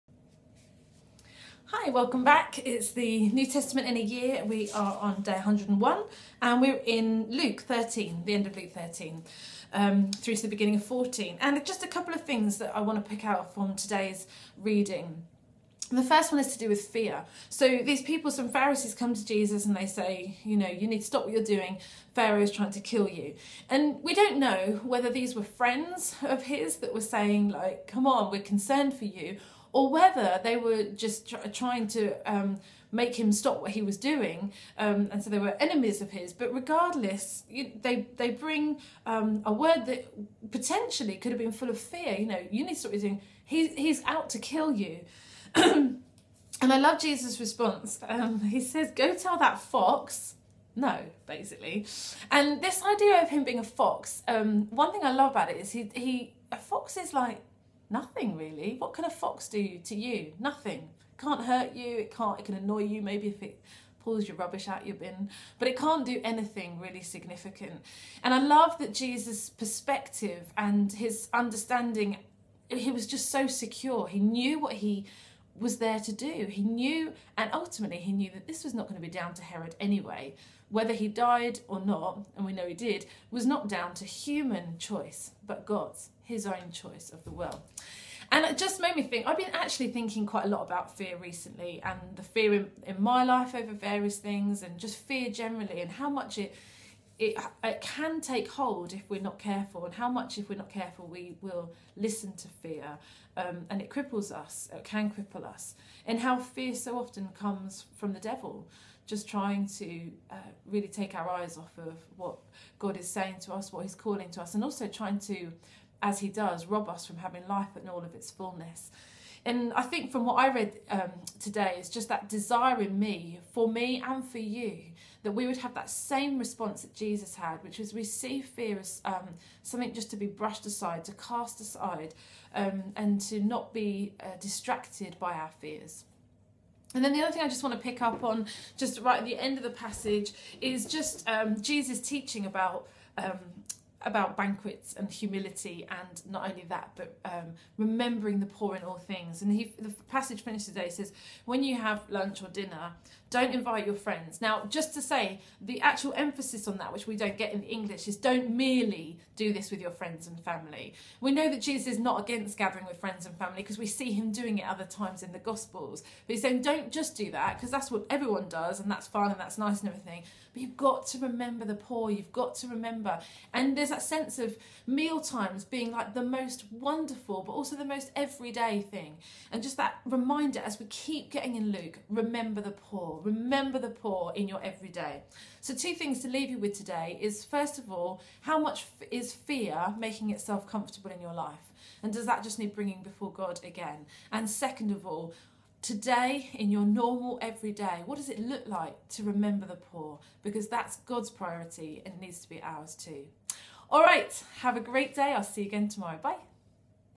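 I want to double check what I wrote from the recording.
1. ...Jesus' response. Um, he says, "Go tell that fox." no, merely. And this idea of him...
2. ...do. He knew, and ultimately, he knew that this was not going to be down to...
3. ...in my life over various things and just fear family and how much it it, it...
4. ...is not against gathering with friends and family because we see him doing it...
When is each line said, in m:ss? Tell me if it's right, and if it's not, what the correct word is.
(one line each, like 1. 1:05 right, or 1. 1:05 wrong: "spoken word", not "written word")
1. 0:47 wrong: "basically", not "merely"
2. 1:16 right
3. 1:32 wrong: "generally", not "family"
4. 2:41 right.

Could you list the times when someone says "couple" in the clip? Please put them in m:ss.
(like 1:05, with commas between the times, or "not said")
0:11.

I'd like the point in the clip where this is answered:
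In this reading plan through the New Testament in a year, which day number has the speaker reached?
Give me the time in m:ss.
0:05.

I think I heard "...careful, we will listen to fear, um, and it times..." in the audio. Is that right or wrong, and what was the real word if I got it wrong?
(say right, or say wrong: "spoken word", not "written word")
wrong: "cripples", not "times".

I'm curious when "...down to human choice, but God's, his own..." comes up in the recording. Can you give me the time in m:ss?
1:23.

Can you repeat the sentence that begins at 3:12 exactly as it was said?
And does that just need bringing before God again?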